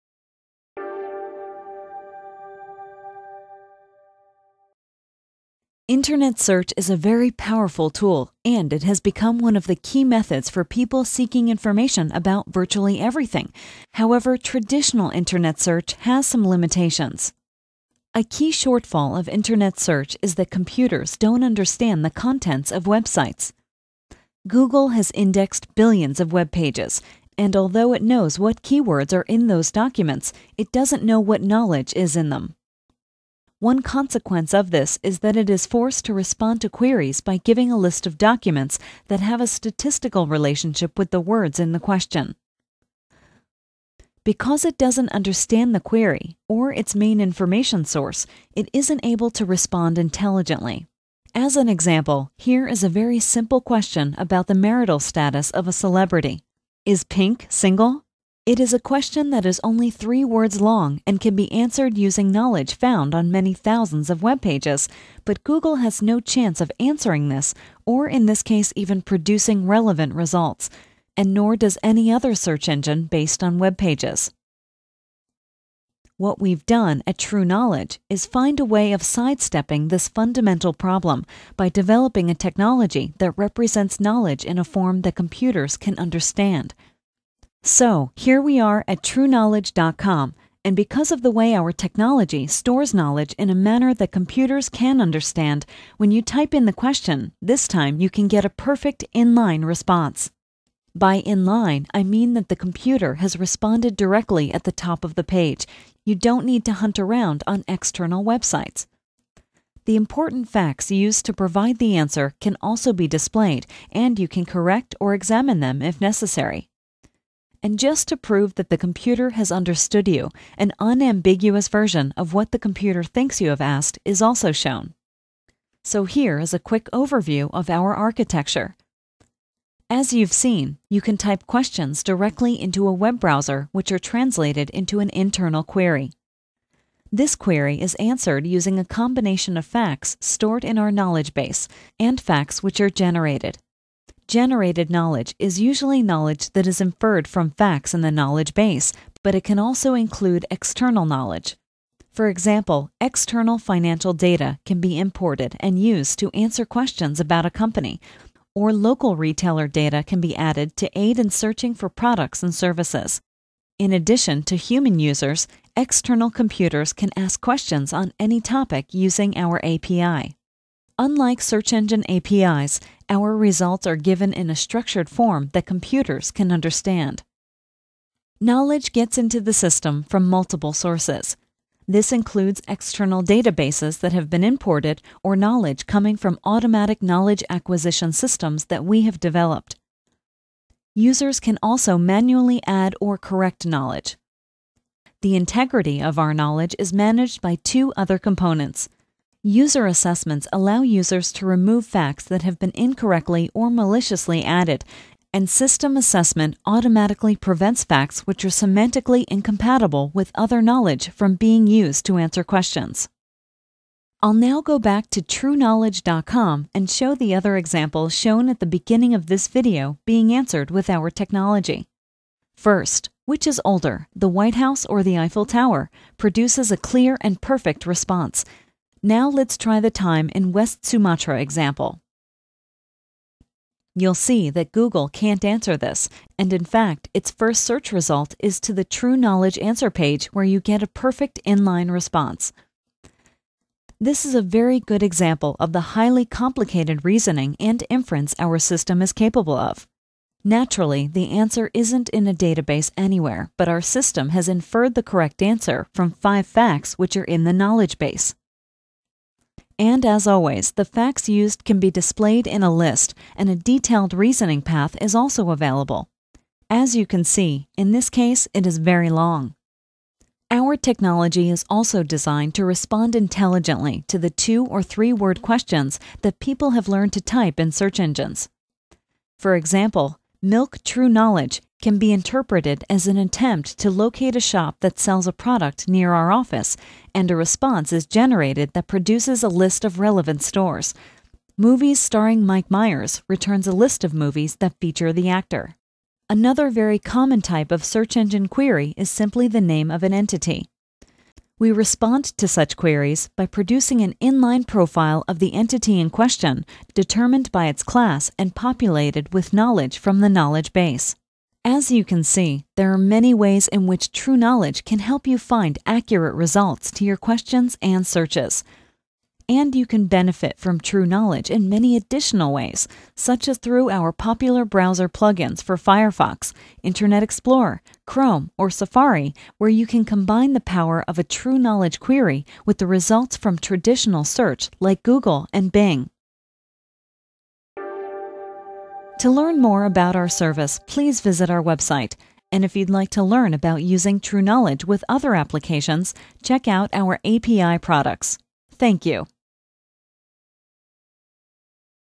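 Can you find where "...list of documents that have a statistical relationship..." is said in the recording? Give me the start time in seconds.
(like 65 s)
37 s.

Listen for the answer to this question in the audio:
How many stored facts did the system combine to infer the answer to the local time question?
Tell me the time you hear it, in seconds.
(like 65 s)
256 s.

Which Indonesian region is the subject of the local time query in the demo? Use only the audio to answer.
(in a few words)
West Sumatra.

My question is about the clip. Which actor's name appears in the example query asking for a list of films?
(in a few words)
Mike Myers.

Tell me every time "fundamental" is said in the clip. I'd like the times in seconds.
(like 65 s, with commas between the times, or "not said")
80 s.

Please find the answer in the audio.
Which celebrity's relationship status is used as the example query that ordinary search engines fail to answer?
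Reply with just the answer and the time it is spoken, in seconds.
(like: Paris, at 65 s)
Pink, at 57 s.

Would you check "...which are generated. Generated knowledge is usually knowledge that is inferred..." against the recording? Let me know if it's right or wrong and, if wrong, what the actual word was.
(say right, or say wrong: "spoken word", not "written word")
right.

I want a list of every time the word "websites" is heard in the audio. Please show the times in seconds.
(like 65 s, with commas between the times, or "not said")
22 s, 108 s, 341 s.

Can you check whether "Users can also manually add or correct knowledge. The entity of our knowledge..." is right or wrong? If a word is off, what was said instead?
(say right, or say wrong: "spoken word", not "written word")
wrong: "integrity", not "entity".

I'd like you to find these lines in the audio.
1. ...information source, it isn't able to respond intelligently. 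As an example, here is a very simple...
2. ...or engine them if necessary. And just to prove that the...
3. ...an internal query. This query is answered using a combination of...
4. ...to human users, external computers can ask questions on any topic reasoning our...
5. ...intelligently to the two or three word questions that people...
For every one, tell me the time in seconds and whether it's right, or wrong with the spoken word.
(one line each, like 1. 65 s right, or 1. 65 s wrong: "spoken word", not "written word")
1. 47 s right
2. 114 s wrong: "examine", not "engine"
3. 134 s right
4. 164 s wrong: "using", not "reasoning"
5. 273 s right.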